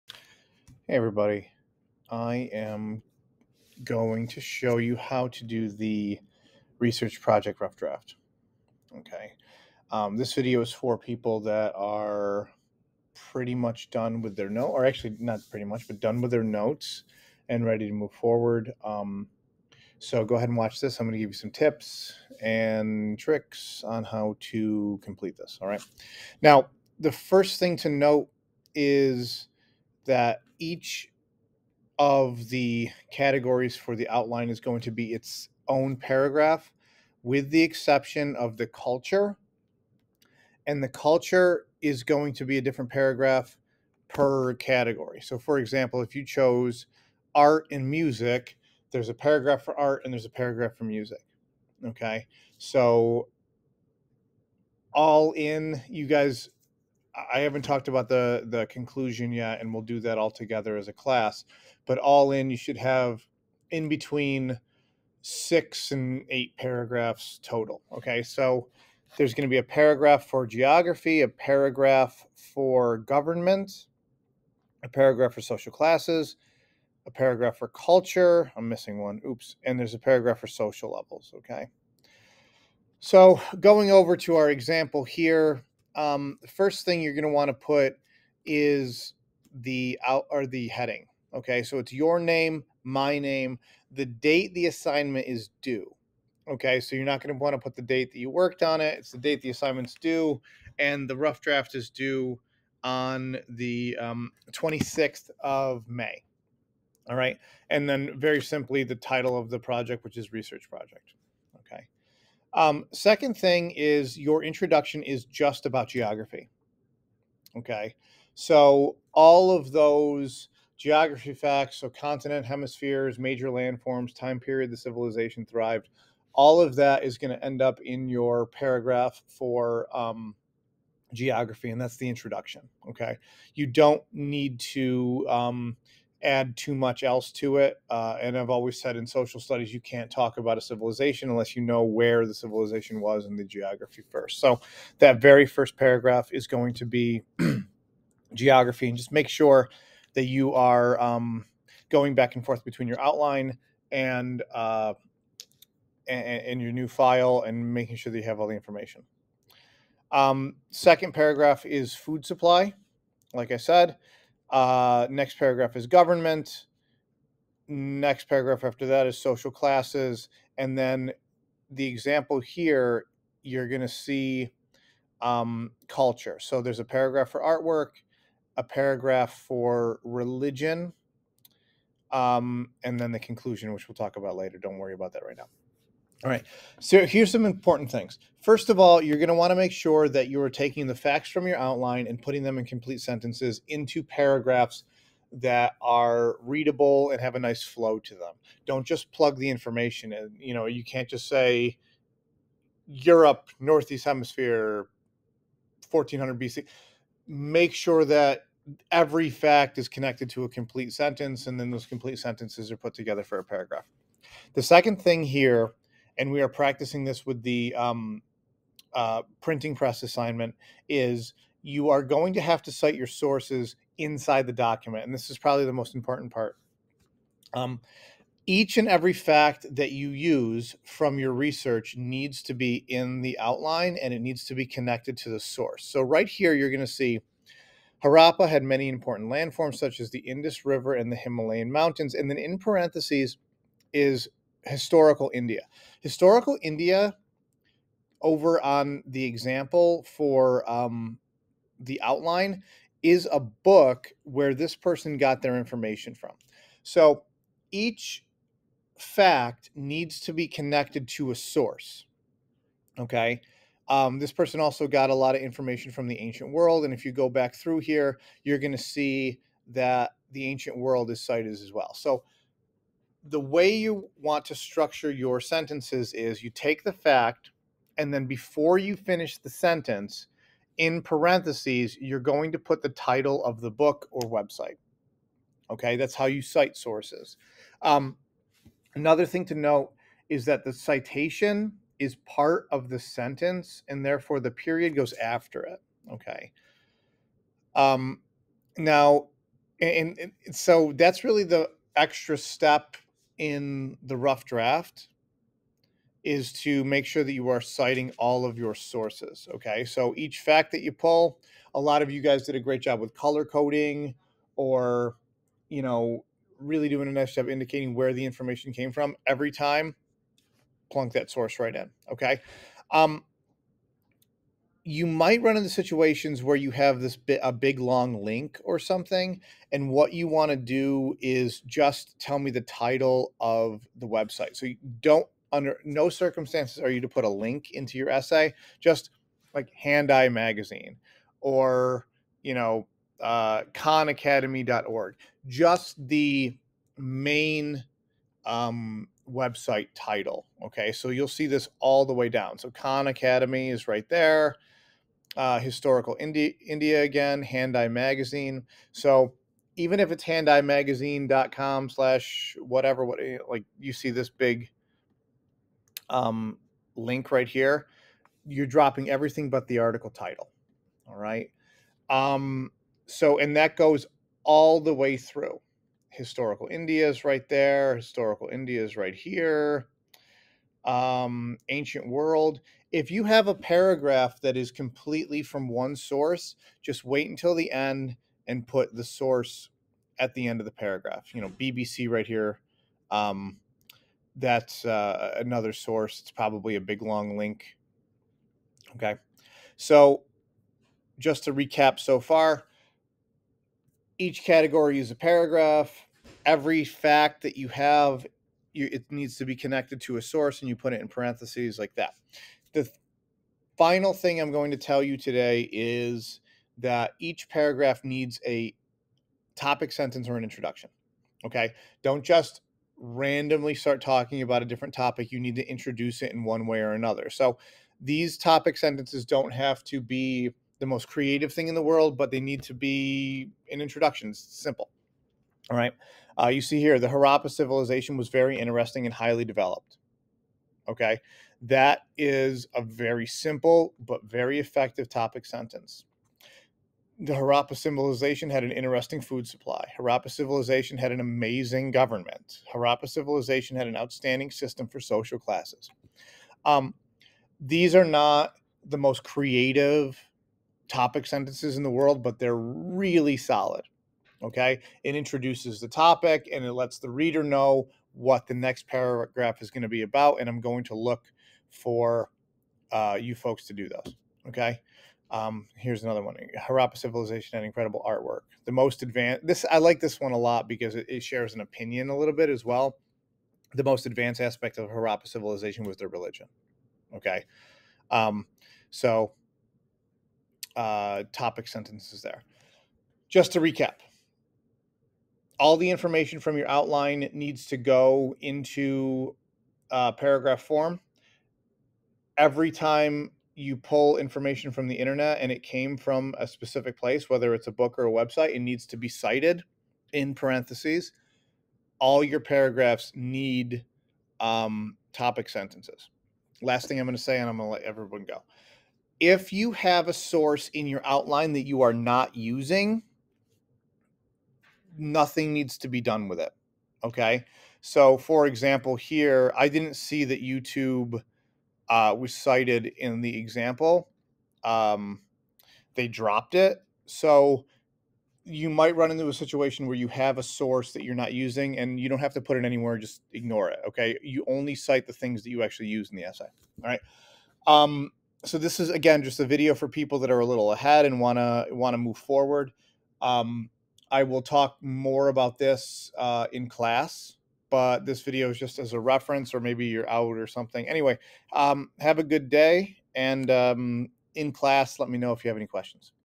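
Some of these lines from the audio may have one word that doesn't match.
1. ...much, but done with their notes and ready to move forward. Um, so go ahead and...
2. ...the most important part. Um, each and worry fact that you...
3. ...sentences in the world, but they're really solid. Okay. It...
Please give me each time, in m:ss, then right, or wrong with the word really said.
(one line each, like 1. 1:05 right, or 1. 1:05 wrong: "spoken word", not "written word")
1. 0:15 right
2. 3:45 wrong: "every", not "worry"
3. 7:41 right.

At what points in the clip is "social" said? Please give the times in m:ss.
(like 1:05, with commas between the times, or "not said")
1:15, 1:20, 2:19, 2:49, 7:34.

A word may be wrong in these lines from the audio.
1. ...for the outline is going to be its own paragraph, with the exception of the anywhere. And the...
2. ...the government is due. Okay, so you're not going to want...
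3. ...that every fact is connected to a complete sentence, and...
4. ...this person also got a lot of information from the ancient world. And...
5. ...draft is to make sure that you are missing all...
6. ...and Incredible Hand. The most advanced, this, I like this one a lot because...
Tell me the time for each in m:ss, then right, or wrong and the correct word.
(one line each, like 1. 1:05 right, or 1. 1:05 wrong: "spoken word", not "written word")
1. 0:33 wrong: "culture", not "anywhere"
2. 1:34 wrong: "assignment", not "government"
3. 3:28 right
4. 4:24 right
5. 5:04 wrong: "citing", not "missing"
6. 7:57 wrong: "Artwork", not "Hand".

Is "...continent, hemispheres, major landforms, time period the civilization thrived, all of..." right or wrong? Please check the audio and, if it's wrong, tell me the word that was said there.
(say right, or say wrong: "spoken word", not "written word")
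right.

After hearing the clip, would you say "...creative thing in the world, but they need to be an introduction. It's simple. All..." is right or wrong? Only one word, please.
right.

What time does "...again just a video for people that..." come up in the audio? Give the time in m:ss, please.
9:08.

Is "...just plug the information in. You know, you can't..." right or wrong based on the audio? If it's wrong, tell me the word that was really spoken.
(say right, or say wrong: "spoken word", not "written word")
right.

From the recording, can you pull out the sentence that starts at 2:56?
So there's a paragraph for artwork, a paragraph for religion, um, and then the conclusion, which we'll talk about later.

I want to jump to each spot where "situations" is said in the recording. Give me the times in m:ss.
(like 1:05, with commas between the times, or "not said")
5:25, 8:59.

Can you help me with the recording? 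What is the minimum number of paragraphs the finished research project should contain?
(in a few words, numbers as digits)
6.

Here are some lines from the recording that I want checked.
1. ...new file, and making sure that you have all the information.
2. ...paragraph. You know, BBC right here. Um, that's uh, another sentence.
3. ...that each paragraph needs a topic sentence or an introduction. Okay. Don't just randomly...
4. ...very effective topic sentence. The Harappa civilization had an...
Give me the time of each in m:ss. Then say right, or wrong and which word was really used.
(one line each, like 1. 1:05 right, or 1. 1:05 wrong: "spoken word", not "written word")
1. 2:36 right
2. 6:30 wrong: "source", not "sentence"
3. 6:56 right
4. 7:24 right.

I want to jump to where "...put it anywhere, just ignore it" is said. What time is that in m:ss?
9:02.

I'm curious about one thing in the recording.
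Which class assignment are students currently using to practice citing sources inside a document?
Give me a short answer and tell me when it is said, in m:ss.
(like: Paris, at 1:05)
Printing press assignment, at 3:39.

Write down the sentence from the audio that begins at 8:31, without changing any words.
All your paragraphs need um, topic sentences.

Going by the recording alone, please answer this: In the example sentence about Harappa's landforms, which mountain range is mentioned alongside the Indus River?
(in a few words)
Himalayan mountains.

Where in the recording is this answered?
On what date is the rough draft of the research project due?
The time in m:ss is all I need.
1:44.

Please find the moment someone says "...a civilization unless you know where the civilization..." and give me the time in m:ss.
2:20.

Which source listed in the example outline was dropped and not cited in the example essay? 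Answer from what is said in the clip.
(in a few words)
YouTube.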